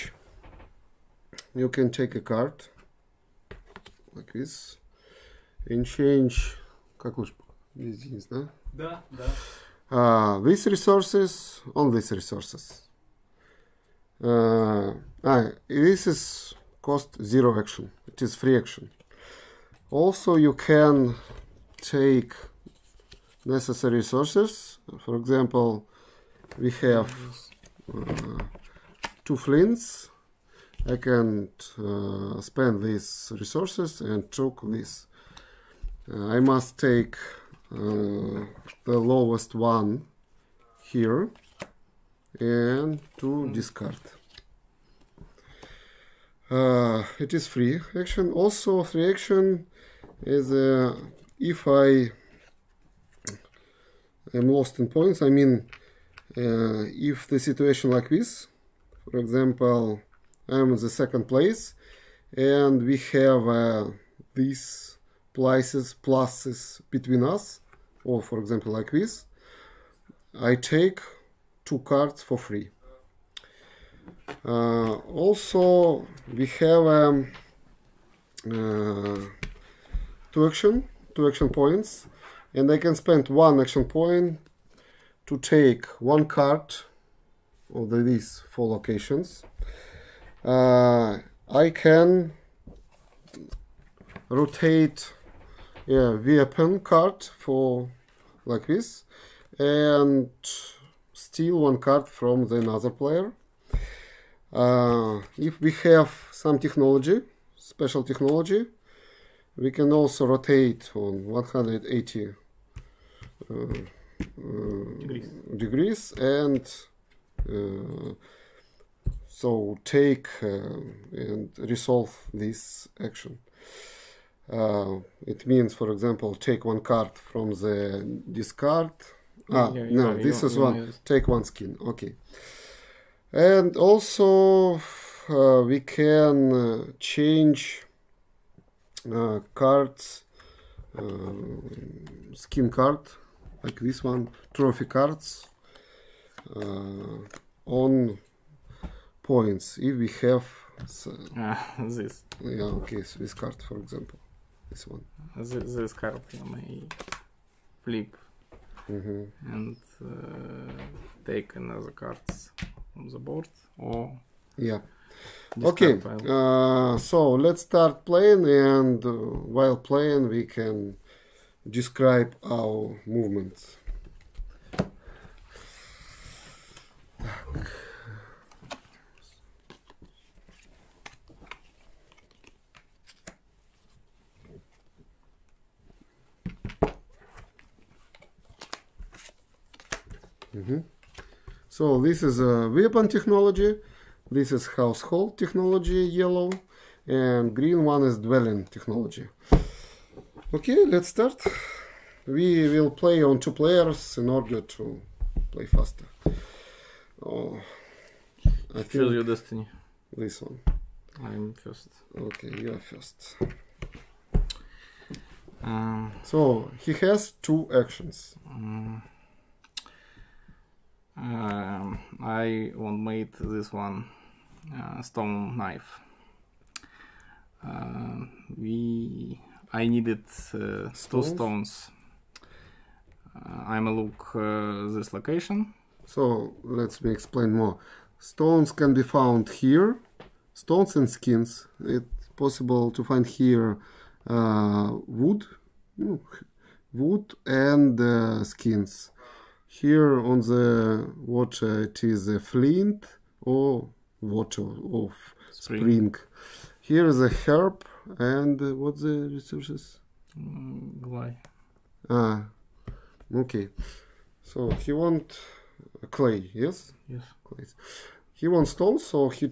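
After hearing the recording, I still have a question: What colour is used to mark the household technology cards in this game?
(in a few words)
Yellow.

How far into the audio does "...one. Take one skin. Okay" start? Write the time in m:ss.
2:10.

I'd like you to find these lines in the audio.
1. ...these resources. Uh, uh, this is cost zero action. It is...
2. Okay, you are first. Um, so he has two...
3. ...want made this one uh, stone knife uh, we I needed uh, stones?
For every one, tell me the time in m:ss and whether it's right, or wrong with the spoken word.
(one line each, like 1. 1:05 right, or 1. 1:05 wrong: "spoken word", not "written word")
1. 0:11 right
2. 3:32 right
3. 3:42 right.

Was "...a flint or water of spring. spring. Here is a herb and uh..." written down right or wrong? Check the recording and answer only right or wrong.
right.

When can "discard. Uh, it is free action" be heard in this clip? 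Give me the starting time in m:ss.
0:43.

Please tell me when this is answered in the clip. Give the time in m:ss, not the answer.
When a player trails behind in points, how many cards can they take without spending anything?
1:11.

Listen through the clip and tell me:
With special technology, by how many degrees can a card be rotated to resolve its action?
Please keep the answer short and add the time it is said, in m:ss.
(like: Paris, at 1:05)
180, at 1:51.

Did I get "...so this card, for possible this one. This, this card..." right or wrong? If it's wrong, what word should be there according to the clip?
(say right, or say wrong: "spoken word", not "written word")
wrong: "example", not "possible".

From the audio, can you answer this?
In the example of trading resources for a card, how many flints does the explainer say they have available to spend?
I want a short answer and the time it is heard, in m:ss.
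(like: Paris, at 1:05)
2, at 0:29.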